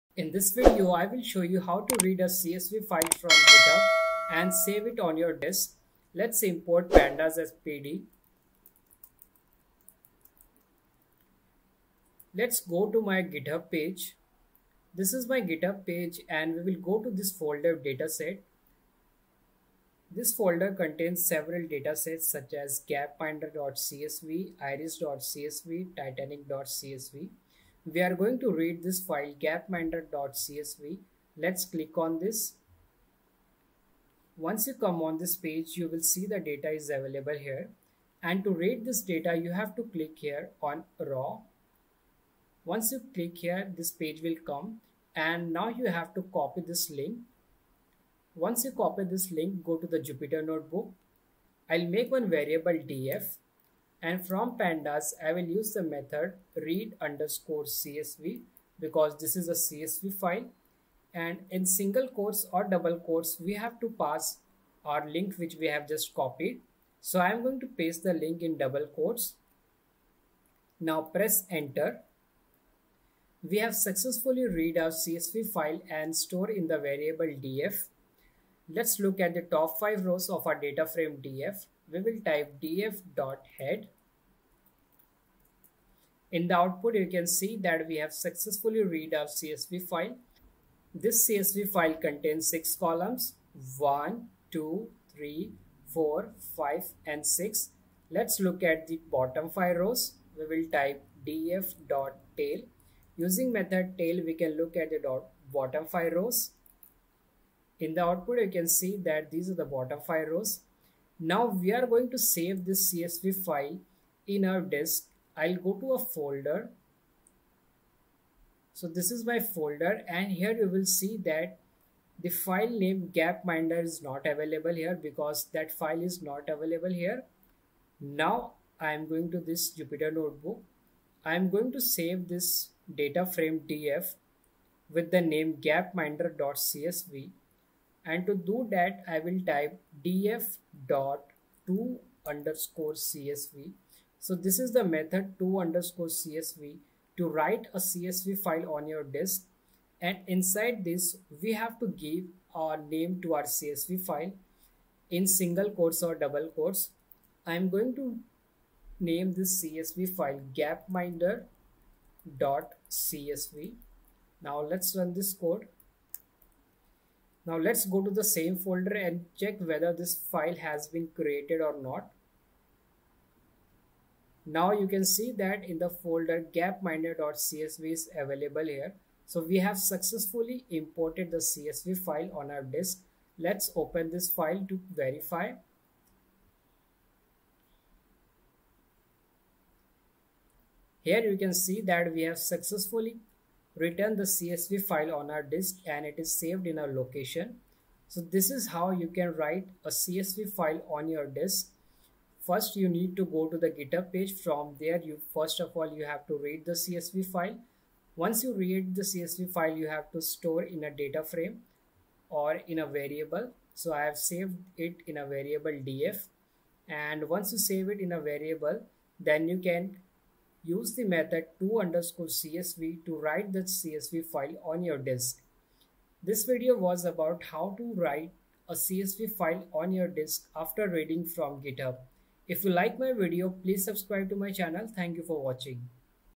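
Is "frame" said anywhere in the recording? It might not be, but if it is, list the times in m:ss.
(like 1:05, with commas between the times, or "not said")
1:20, 2:13, 3:31.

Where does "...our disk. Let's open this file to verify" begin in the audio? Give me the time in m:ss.
3:02.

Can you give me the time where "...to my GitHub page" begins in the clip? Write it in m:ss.
0:12.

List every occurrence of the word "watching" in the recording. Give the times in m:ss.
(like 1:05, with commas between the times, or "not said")
3:55.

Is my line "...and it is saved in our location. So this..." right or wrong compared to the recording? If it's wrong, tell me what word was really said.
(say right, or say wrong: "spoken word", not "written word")
right.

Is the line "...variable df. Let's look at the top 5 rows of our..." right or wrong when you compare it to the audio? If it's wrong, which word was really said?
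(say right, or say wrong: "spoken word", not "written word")
right.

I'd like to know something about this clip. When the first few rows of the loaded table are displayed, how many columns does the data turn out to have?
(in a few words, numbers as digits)
6.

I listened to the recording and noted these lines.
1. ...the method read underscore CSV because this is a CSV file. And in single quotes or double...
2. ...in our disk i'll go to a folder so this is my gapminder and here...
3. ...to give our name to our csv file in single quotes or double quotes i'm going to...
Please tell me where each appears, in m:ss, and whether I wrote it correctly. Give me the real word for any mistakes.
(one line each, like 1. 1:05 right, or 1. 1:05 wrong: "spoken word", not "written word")
1. 0:55 right
2. 1:54 wrong: "folder", not "gapminder"
3. 2:31 right.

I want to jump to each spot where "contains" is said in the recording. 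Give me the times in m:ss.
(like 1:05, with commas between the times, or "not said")
0:20, 1:31.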